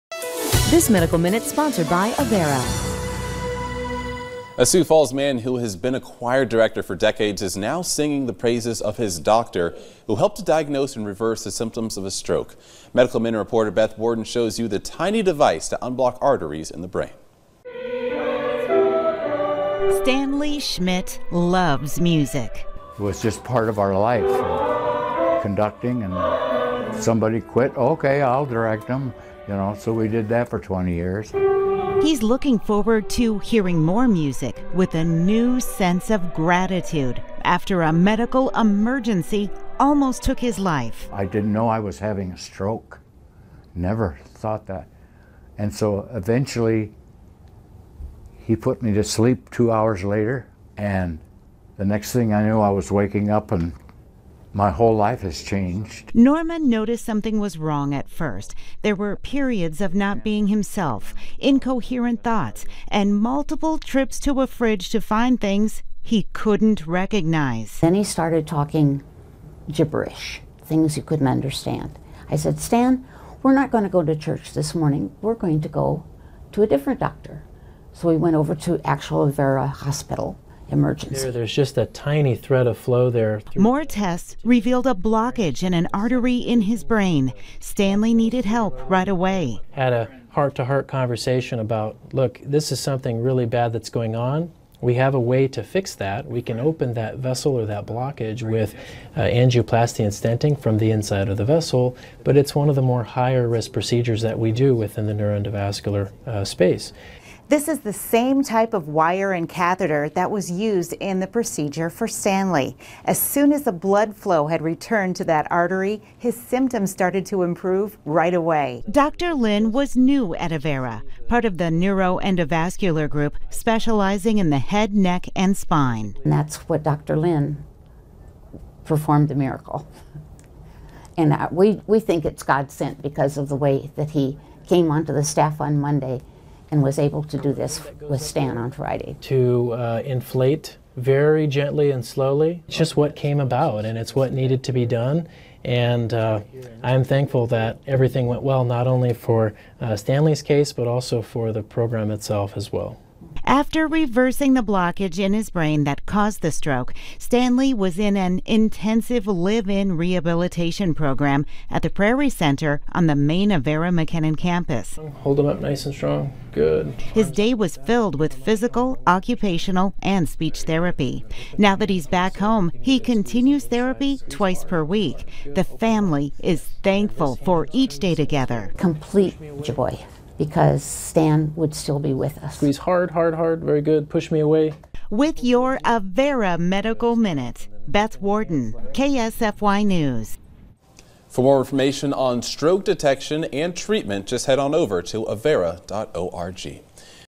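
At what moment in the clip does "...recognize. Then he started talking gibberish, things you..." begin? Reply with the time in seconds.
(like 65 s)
66 s.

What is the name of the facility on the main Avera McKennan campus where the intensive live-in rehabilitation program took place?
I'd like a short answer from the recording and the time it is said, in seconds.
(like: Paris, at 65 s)
Prairie Center, at 161 s.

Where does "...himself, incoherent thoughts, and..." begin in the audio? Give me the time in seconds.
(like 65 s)
60 s.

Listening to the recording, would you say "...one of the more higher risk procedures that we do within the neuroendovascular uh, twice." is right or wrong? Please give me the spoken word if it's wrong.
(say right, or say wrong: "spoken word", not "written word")
wrong: "space", not "twice".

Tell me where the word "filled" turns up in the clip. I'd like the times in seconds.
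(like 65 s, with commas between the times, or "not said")
167 s.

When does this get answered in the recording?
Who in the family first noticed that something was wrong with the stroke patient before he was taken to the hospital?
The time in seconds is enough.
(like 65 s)
56 s.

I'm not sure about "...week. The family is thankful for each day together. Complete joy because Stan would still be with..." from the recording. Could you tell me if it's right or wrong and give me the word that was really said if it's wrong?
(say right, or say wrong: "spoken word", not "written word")
right.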